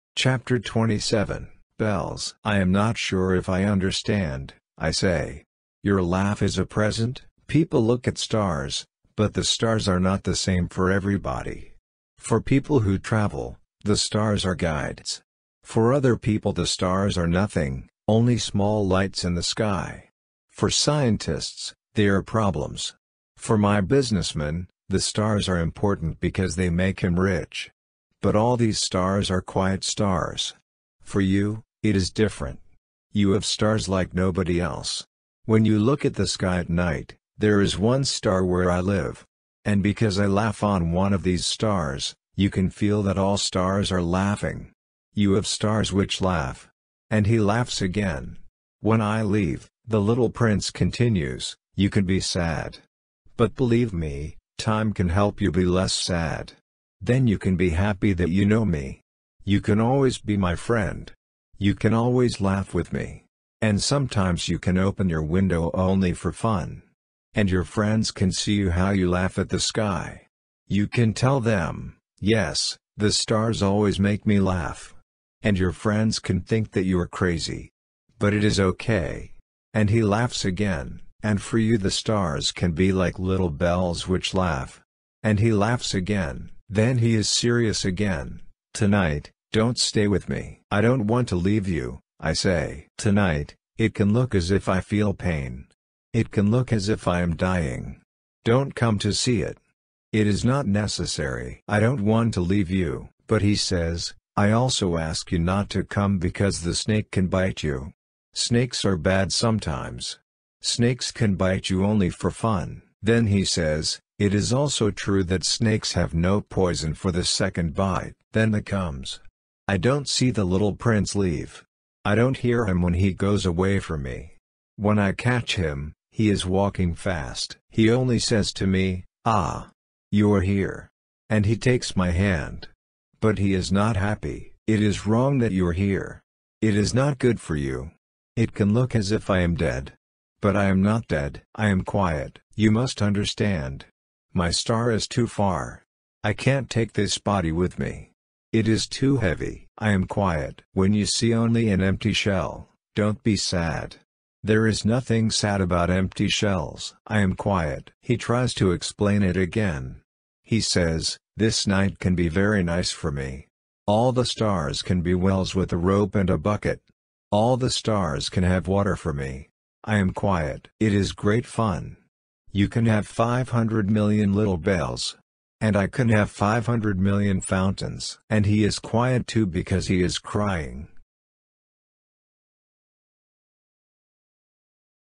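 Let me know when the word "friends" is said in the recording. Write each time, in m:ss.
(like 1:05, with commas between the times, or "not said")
1:00, 1:07, 1:15.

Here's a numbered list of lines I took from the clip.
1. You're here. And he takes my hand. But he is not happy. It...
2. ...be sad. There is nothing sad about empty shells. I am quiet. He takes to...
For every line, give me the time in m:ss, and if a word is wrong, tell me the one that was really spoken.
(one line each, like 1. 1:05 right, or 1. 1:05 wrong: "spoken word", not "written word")
1. 2:10 right
2. 2:33 wrong: "tries", not "takes".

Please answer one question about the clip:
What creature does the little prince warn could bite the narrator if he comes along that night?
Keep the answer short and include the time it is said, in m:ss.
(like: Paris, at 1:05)
The snake, at 1:46.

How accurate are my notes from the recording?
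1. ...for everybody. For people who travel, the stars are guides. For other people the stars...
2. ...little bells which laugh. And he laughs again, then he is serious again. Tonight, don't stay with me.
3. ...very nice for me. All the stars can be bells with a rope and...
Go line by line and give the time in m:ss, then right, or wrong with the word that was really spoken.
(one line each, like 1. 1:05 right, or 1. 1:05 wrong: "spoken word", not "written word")
1. 0:10 right
2. 1:23 right
3. 2:42 wrong: "wells", not "bells".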